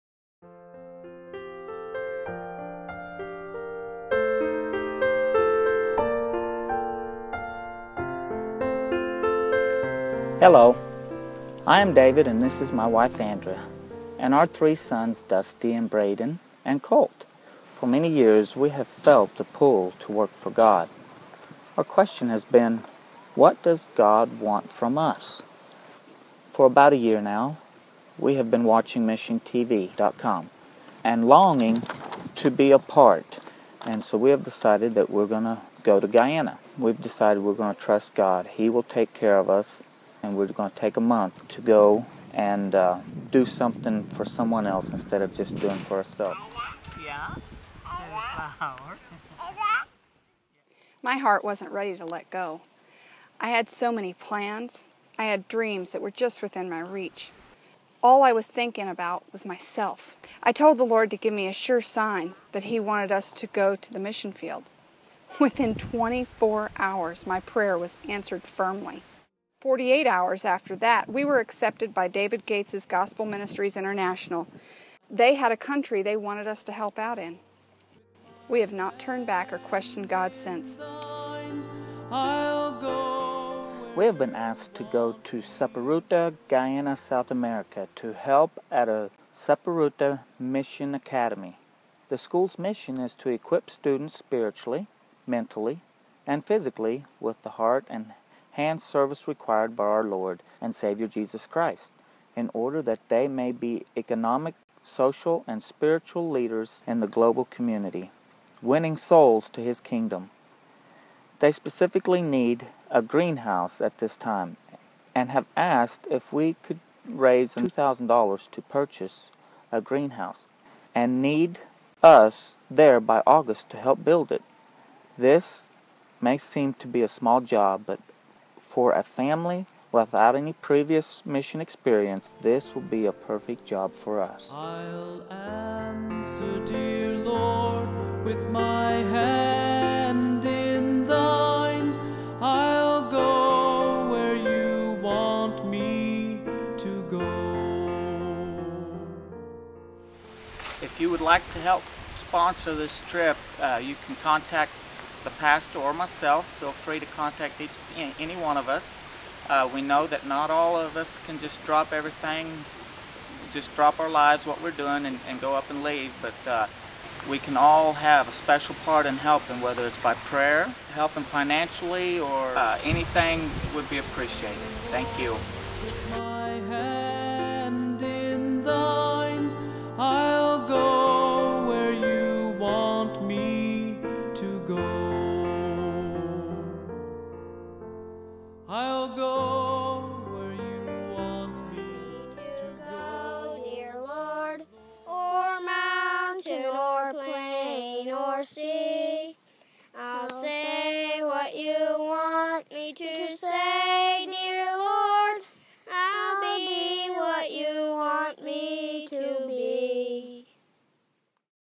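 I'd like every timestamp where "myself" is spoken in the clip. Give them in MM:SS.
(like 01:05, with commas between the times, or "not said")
00:59, 02:35.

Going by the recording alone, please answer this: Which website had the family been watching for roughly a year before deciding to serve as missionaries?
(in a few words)
MissionTV.com.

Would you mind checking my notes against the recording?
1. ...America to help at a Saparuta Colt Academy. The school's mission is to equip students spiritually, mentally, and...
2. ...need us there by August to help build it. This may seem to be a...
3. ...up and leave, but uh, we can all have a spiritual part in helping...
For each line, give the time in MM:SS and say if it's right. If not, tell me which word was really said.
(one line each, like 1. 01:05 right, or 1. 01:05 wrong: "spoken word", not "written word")
1. 01:27 wrong: "Mission", not "Colt"
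2. 02:01 right
3. 02:45 wrong: "special", not "spiritual".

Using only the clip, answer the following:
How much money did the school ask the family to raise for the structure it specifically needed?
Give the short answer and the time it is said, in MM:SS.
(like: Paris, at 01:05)
$2,000, at 01:57.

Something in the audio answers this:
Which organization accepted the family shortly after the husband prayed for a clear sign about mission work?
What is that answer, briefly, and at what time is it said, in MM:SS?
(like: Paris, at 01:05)
Gospel Ministries International, at 01:12.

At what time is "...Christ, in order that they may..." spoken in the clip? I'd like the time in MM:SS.
01:41.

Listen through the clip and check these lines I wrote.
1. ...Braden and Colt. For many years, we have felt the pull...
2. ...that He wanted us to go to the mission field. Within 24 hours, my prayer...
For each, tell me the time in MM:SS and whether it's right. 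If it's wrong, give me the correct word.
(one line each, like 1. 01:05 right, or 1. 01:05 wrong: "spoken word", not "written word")
1. 00:15 right
2. 01:02 right.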